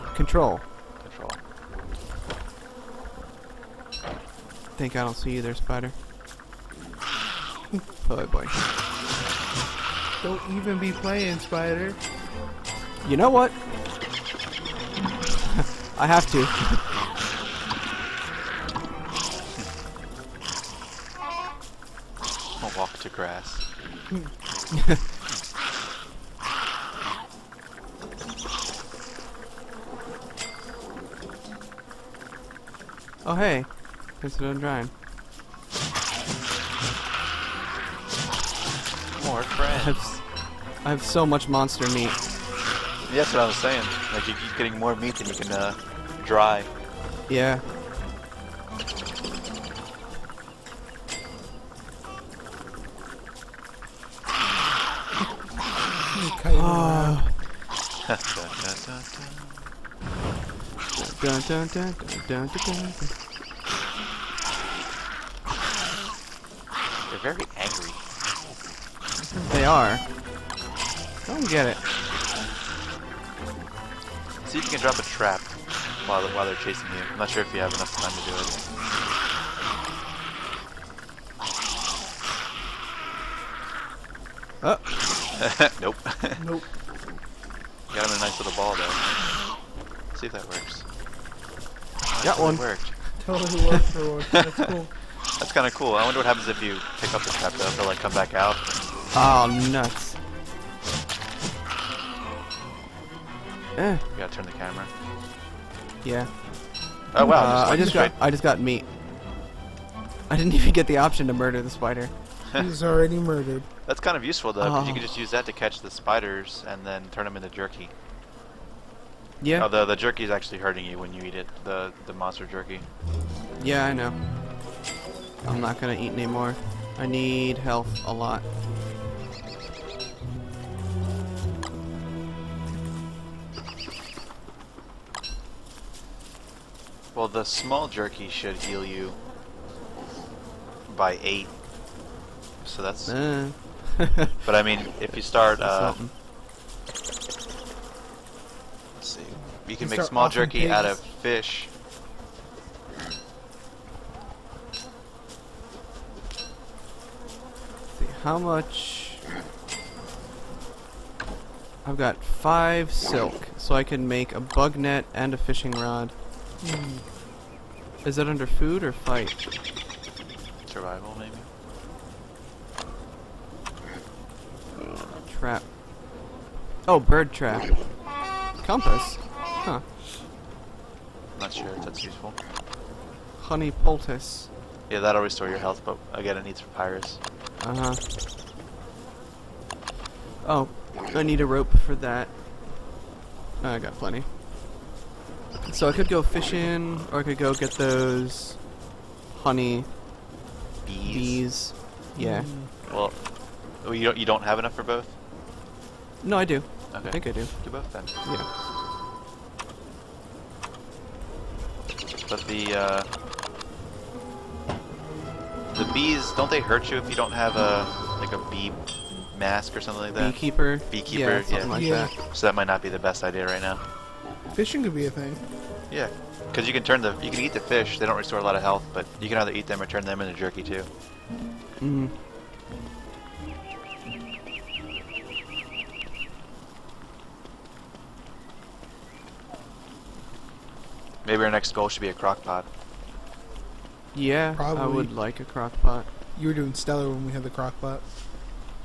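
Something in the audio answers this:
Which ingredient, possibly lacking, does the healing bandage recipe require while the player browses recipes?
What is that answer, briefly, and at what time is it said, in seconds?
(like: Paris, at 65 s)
papyrus, at 186 s.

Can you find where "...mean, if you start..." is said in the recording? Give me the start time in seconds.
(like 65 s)
144 s.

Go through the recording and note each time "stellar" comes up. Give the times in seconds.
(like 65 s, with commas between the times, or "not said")
246 s.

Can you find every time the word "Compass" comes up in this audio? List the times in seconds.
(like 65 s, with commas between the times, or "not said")
178 s.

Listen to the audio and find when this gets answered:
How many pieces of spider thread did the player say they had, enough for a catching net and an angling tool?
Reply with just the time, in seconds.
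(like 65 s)
162 s.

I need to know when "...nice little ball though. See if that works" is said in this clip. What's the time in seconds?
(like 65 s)
88 s.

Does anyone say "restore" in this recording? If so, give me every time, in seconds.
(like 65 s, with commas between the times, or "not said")
185 s, 228 s.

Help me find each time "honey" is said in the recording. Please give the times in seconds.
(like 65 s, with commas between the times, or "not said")
183 s, 199 s.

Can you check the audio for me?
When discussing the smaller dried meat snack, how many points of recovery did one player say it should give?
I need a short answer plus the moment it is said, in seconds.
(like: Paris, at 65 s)
8, at 141 s.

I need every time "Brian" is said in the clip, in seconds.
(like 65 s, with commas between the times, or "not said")
not said.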